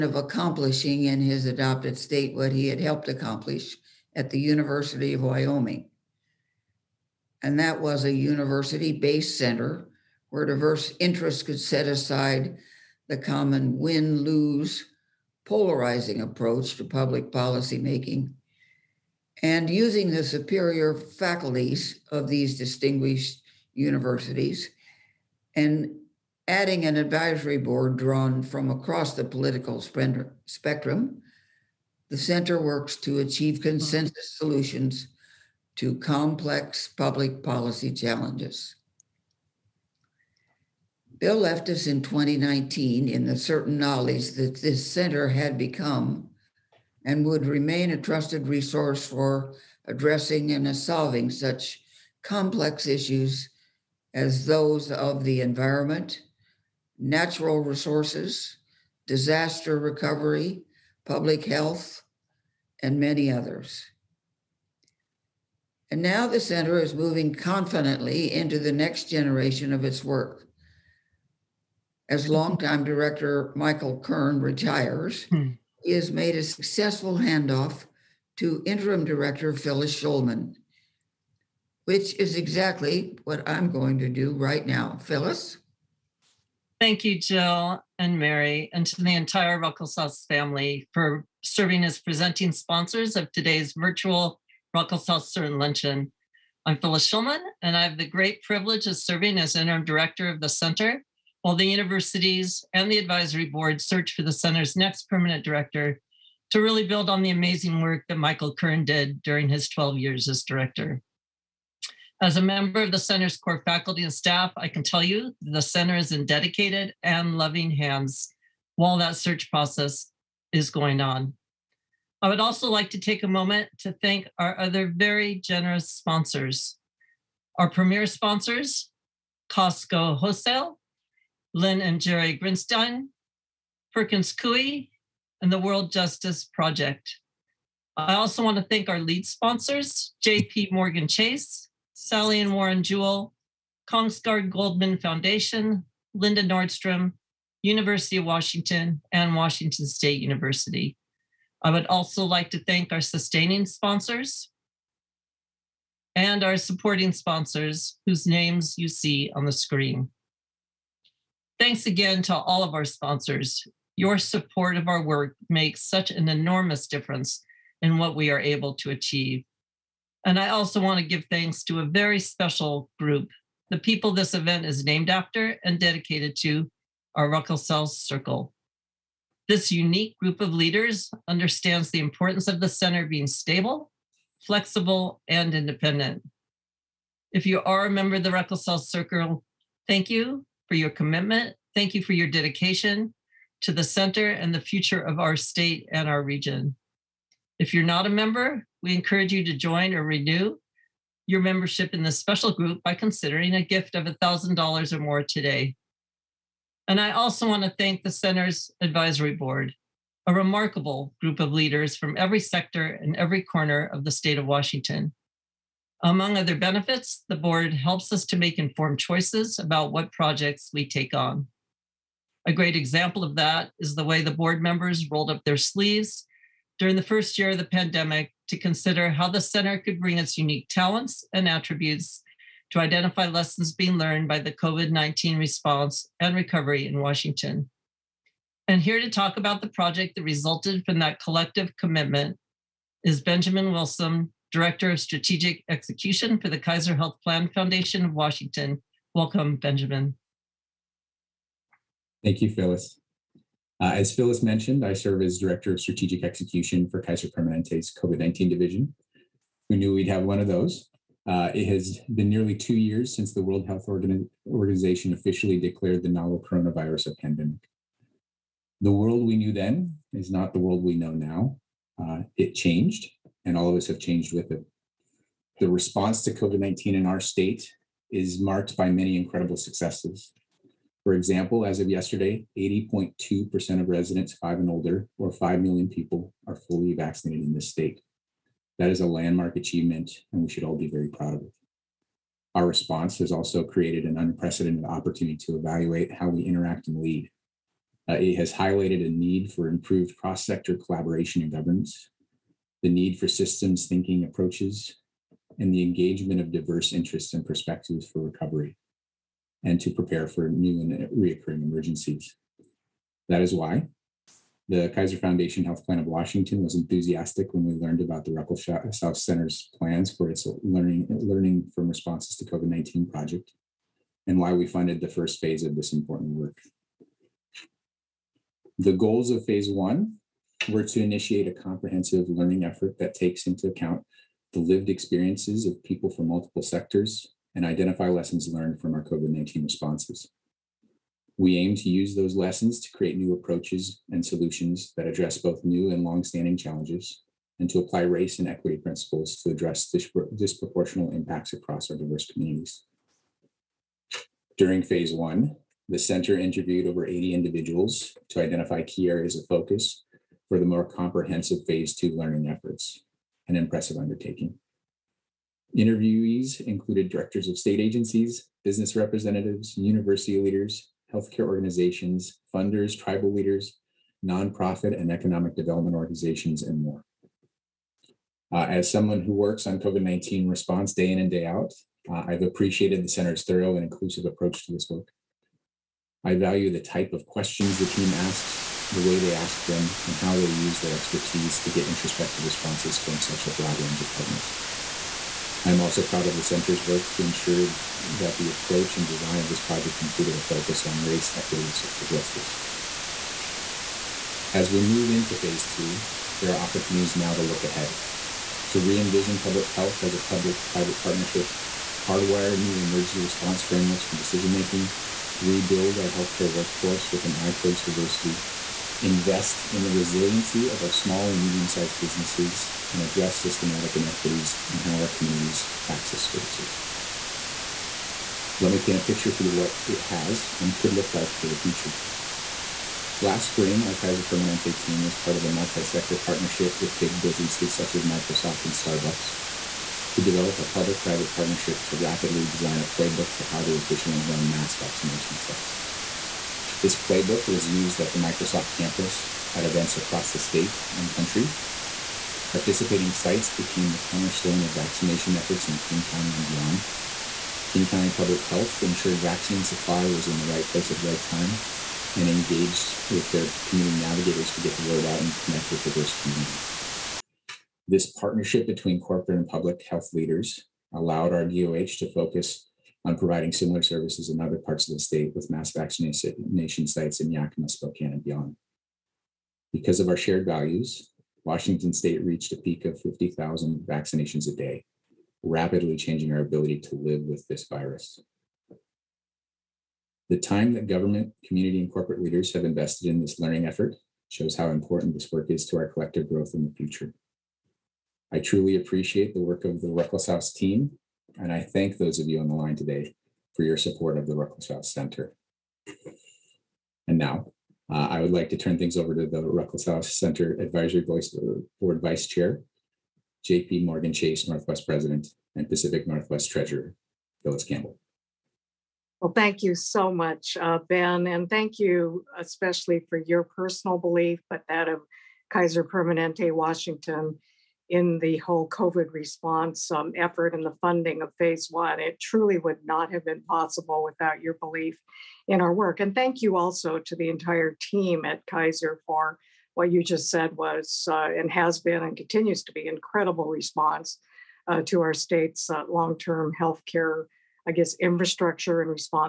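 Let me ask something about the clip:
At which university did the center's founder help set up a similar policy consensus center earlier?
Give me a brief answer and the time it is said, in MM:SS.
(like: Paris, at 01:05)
University of Wyoming, at 00:04.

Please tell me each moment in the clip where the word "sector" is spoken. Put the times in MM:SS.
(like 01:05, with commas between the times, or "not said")
03:32, 05:00, 05:36, 07:15.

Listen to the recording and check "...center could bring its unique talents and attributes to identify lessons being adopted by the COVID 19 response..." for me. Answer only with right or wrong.
wrong.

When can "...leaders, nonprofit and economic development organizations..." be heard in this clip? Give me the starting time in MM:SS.
06:13.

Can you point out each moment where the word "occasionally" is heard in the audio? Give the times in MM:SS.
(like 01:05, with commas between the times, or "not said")
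not said.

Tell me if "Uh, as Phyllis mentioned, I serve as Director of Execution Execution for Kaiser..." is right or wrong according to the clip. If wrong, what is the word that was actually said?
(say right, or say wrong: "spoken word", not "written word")
wrong: "Strategic", not "Execution".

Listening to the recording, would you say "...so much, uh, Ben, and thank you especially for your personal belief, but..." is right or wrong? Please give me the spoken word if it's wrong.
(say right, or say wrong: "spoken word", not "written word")
right.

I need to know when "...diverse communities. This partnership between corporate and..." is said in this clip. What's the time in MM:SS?
07:45.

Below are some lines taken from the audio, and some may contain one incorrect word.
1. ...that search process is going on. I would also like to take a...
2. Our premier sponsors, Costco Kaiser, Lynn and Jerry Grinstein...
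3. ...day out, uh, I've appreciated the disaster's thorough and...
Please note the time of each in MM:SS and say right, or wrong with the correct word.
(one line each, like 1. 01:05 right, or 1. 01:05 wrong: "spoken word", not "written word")
1. 01:58 right
2. 02:07 wrong: "Wholesale", not "Kaiser"
3. 06:21 wrong: "center", not "disaster".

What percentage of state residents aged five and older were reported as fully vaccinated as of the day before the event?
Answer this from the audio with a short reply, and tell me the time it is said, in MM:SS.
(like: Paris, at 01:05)
80.2%, at 04:42.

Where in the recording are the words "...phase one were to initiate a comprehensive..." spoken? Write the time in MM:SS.
05:29.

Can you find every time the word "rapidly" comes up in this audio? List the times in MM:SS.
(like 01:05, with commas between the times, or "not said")
07:21, 08:05.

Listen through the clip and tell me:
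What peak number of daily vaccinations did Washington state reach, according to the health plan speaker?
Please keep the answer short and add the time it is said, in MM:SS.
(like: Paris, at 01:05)
50,000, at 08:02.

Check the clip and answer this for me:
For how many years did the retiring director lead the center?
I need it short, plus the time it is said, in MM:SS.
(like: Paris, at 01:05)
12, at 01:49.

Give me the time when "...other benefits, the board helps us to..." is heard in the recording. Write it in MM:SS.
03:36.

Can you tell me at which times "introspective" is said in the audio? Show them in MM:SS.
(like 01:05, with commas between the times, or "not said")
06:31.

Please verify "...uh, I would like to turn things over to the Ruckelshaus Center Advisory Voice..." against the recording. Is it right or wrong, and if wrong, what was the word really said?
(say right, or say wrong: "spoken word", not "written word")
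right.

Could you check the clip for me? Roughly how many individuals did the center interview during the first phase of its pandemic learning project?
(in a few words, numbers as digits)
80.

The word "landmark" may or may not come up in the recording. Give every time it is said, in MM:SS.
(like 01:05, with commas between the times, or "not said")
04:49.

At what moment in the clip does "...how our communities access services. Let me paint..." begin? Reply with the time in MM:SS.
07:04.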